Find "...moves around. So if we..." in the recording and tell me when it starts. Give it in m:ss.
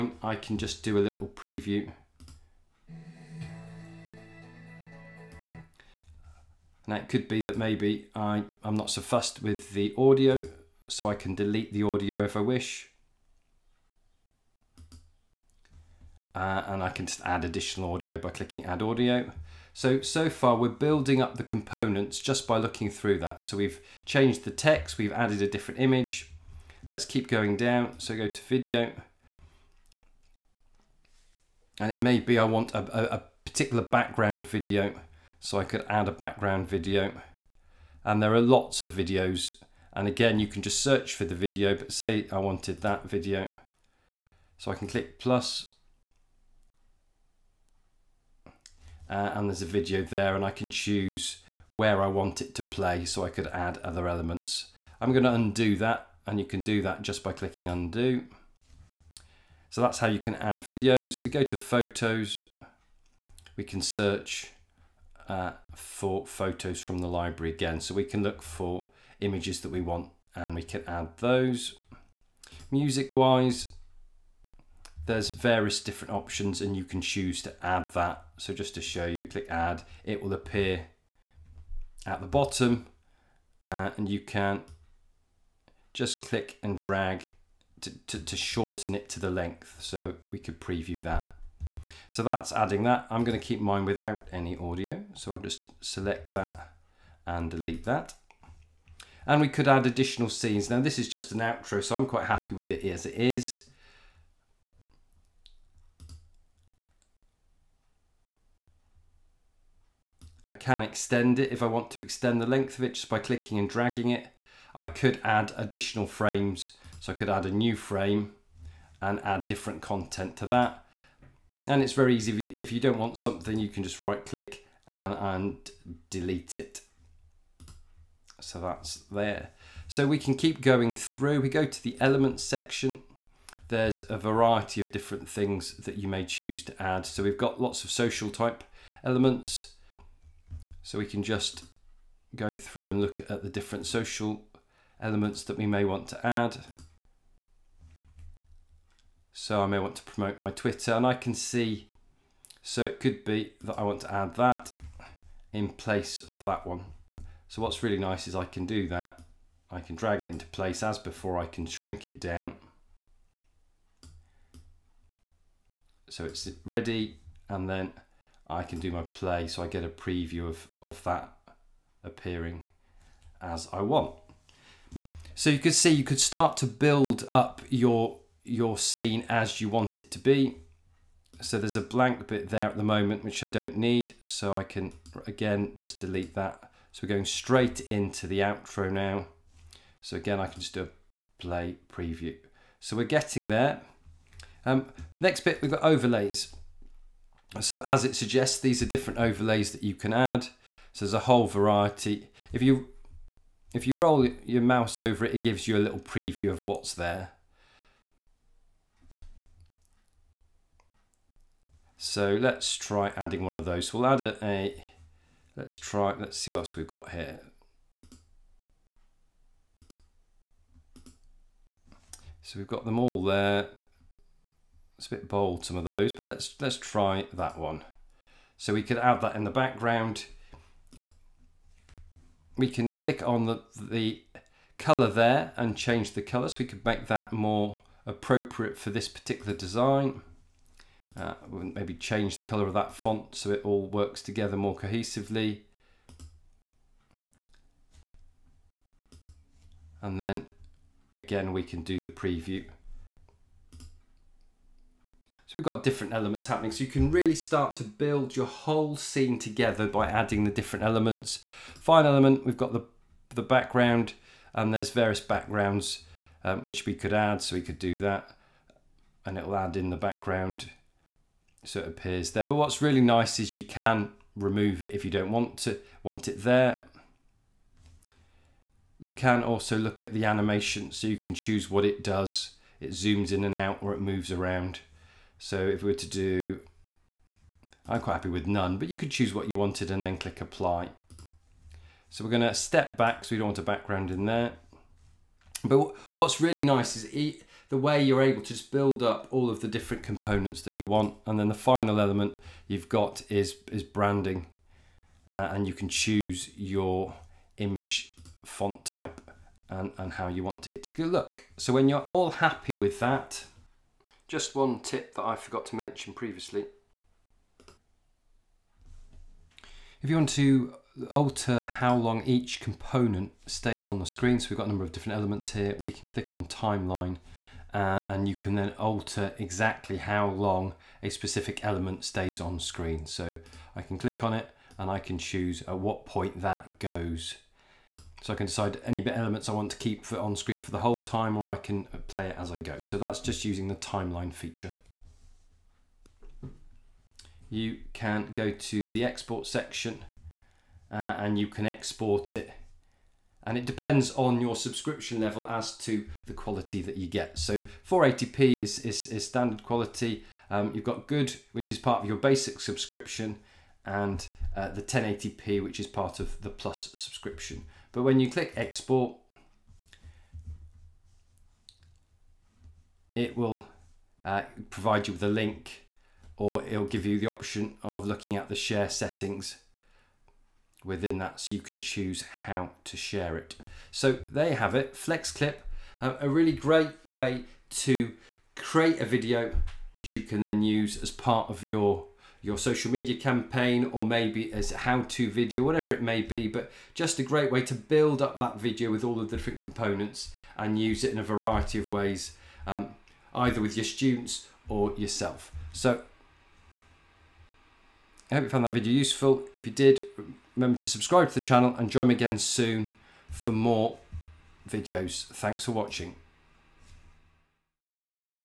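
4:44.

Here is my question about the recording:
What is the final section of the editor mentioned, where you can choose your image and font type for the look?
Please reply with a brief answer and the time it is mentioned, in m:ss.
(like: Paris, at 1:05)
Branding, at 5:03.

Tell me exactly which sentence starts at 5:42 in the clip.
So that's just using the timeline feature.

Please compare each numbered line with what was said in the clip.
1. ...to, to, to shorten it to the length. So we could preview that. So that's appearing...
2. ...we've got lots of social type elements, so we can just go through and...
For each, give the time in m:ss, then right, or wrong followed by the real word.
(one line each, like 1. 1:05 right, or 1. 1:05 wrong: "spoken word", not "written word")
1. 1:27 wrong: "adding", not "appearing"
2. 2:17 right.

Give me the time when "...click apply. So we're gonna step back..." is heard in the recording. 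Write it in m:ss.
4:50.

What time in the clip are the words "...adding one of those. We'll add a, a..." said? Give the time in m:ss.
3:33.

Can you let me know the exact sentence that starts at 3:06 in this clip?
So we're going straight into the outro now.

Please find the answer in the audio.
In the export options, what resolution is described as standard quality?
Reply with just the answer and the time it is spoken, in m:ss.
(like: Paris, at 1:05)
480p, at 5:57.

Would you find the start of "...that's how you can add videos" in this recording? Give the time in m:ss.
0:59.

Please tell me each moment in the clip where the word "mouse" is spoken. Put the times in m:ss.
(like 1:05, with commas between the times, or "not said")
3:24.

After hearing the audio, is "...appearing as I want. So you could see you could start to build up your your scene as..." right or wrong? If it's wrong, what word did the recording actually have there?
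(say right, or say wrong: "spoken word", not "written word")
right.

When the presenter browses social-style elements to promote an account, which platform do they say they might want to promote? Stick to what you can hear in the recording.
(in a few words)
Twitter.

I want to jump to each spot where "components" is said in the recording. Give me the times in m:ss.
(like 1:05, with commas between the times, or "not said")
0:21, 5:00, 5:22, 6:39.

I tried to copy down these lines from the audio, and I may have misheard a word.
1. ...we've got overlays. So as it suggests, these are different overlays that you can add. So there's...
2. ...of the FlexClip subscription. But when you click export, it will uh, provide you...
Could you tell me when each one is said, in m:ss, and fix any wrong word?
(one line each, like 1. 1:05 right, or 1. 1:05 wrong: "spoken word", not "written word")
1. 3:15 right
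2. 6:06 wrong: "Plus", not "FlexClip".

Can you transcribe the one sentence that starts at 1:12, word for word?
Music wise, there's various different options and you can choose to add that.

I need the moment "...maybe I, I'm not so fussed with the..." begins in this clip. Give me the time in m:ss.
0:07.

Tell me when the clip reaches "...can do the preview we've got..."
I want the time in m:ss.
4:11.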